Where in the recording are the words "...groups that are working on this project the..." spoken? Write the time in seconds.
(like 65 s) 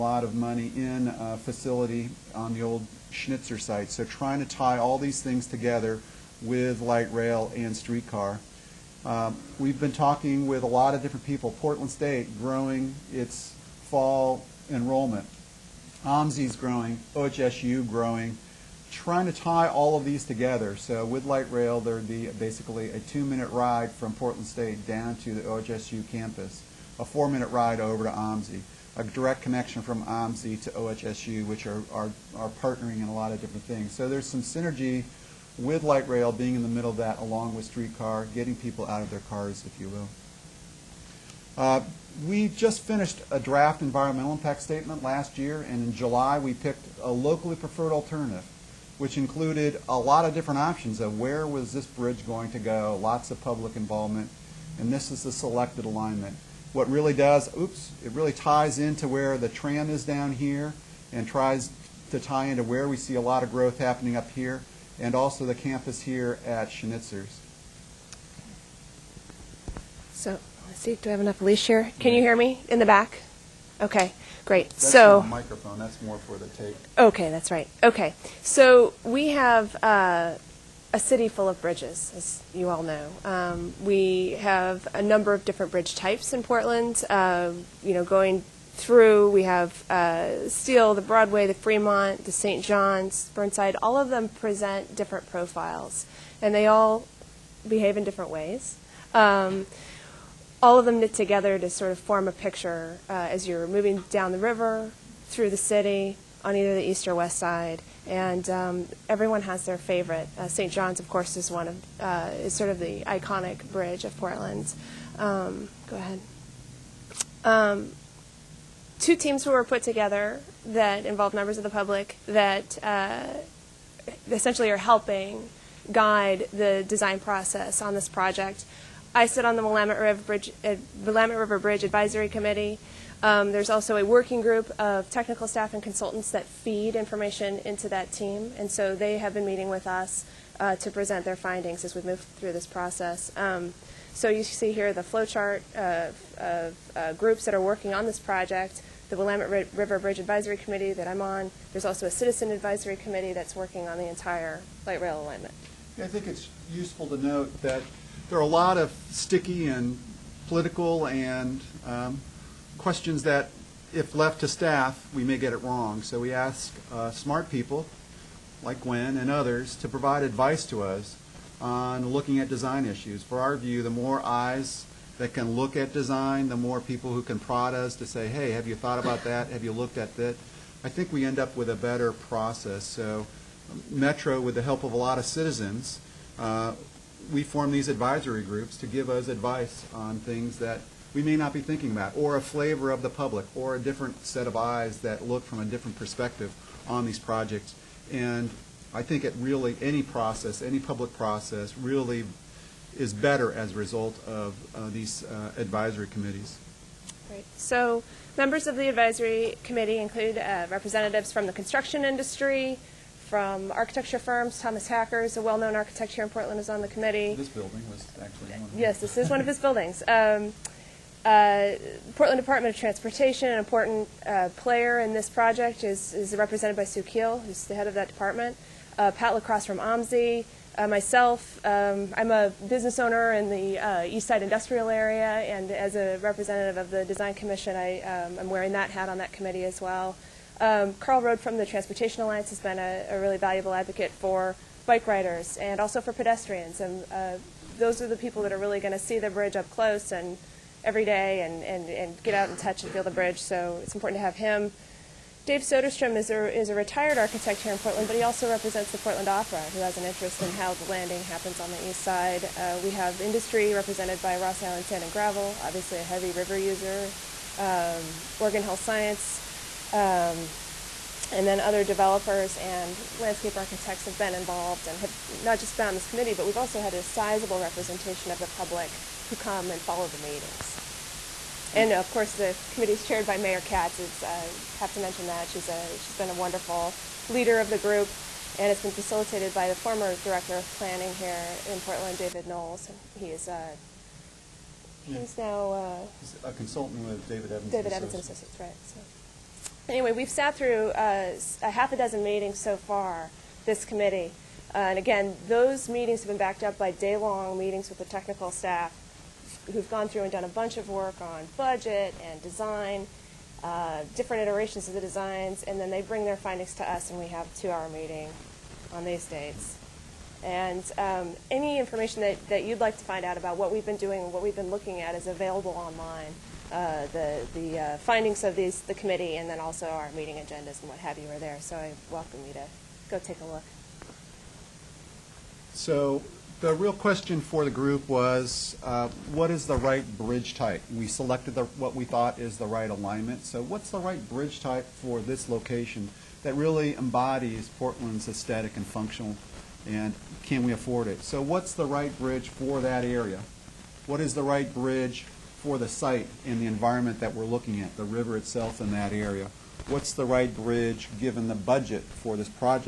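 147 s.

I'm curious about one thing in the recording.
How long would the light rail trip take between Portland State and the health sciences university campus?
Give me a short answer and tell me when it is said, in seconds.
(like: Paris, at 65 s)
2 minutes, at 22 s.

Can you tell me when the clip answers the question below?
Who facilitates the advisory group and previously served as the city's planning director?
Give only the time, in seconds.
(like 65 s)
292 s.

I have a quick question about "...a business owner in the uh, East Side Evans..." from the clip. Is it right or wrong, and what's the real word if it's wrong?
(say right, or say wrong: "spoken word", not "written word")
wrong: "Industrial", not "Evans".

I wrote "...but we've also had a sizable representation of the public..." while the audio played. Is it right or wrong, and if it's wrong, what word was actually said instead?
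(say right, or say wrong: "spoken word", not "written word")
right.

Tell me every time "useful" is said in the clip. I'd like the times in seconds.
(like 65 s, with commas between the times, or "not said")
156 s.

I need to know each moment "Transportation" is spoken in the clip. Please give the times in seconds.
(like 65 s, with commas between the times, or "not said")
222 s, 241 s.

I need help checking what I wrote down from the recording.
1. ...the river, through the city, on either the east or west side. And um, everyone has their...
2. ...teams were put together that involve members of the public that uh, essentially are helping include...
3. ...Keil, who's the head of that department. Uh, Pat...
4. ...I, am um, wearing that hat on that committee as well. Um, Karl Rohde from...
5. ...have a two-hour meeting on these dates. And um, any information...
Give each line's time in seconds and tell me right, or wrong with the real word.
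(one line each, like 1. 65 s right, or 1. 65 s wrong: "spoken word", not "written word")
1. 104 s right
2. 119 s wrong: "guide", not "include"
3. 227 s right
4. 237 s right
5. 317 s right.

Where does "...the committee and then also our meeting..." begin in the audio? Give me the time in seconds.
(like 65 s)
328 s.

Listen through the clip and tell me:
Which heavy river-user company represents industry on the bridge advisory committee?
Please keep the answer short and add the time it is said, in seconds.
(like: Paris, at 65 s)
Ross Island Sand and Gravel, at 264 s.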